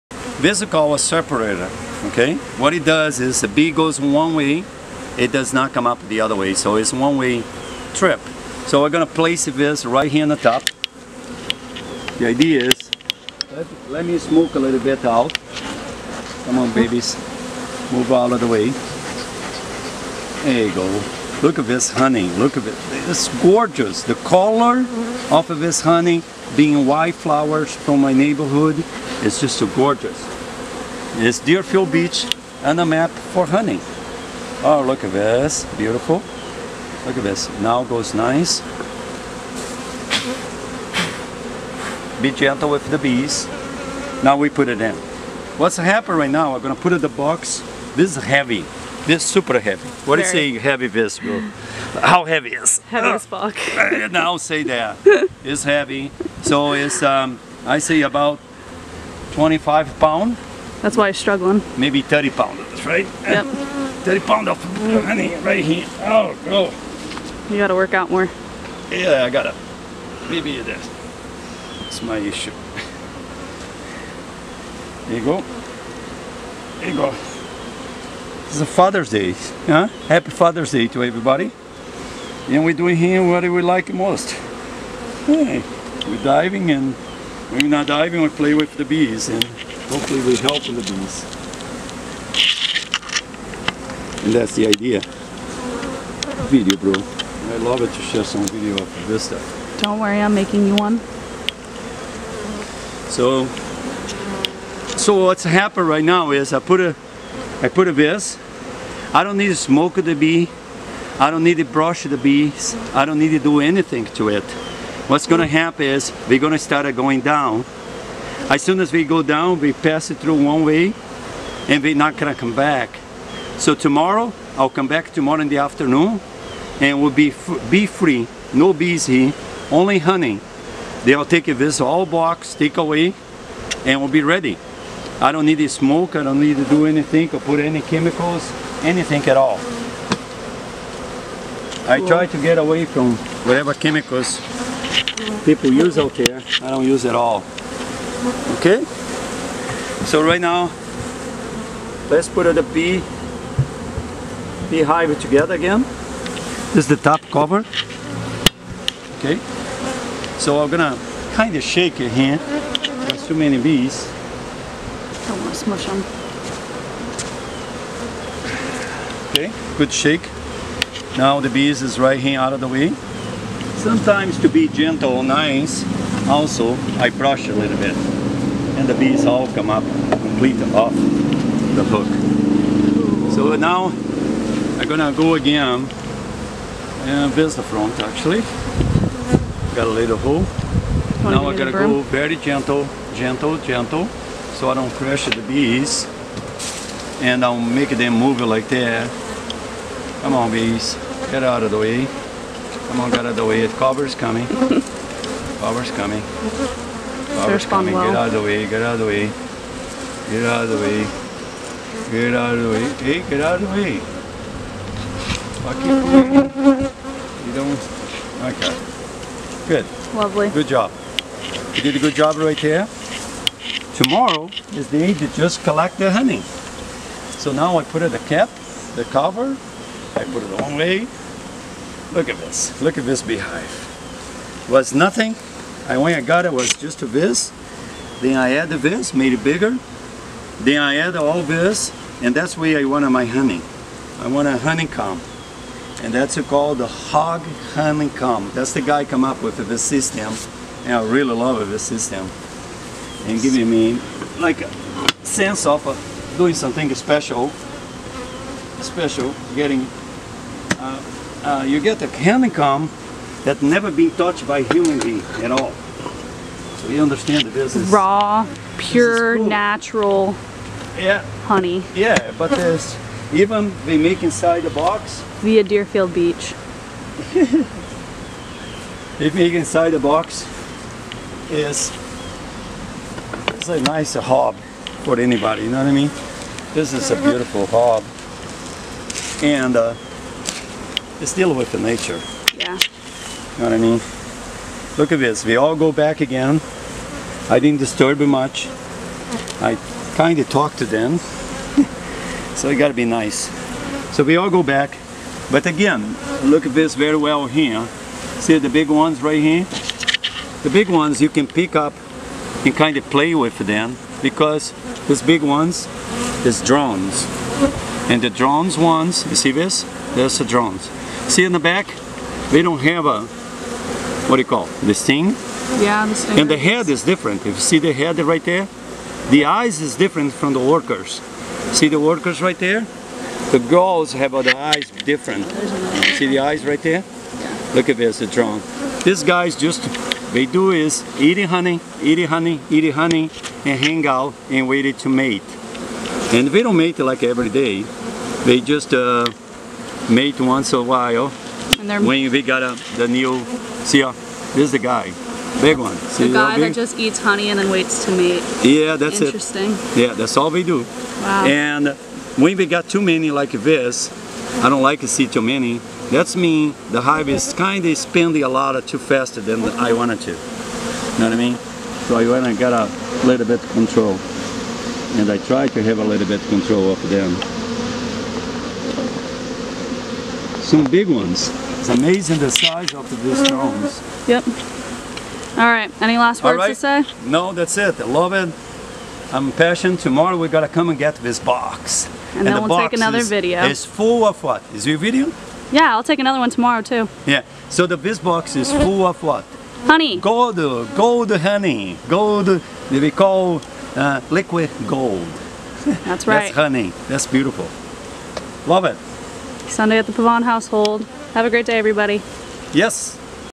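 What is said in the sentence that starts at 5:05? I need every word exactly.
But again, look at this very well here.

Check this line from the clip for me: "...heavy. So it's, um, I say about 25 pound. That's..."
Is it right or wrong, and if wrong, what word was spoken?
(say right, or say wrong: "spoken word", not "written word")
right.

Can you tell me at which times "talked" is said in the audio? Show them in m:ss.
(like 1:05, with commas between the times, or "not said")
5:00.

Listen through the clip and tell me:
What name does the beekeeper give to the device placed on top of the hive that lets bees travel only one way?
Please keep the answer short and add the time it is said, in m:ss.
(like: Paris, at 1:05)
separator, at 0:00.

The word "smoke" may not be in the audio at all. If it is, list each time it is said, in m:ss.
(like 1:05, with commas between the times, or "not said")
0:14, 1:49, 2:15.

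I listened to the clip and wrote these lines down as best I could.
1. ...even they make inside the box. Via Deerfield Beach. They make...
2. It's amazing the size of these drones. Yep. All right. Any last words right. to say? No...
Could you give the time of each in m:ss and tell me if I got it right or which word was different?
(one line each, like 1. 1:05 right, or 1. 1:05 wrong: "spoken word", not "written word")
1. 4:33 right
2. 6:21 right.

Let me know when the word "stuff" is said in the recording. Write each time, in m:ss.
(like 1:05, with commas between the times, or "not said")
1:39.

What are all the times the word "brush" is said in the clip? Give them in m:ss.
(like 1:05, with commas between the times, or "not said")
1:51, 2:57.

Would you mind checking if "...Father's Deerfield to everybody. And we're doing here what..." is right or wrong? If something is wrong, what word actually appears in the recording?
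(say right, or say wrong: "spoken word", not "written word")
wrong: "Day", not "Deerfield".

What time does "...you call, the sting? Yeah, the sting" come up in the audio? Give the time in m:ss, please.
5:24.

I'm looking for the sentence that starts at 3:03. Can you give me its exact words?
So now I'm gonna go again and this the front actually.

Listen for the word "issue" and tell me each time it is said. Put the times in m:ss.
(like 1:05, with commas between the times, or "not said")
1:12.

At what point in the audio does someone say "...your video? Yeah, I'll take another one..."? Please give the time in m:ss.
6:34.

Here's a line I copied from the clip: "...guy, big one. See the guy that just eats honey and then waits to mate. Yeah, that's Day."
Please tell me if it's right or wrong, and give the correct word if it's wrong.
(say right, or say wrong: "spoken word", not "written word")
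wrong: "Interesting", not "Day".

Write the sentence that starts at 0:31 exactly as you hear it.
It's Deerfield Beach and the map for hunting.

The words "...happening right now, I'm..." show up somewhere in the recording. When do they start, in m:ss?
0:45.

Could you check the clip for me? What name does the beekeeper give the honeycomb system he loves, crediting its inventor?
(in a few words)
Hogg honeycomb.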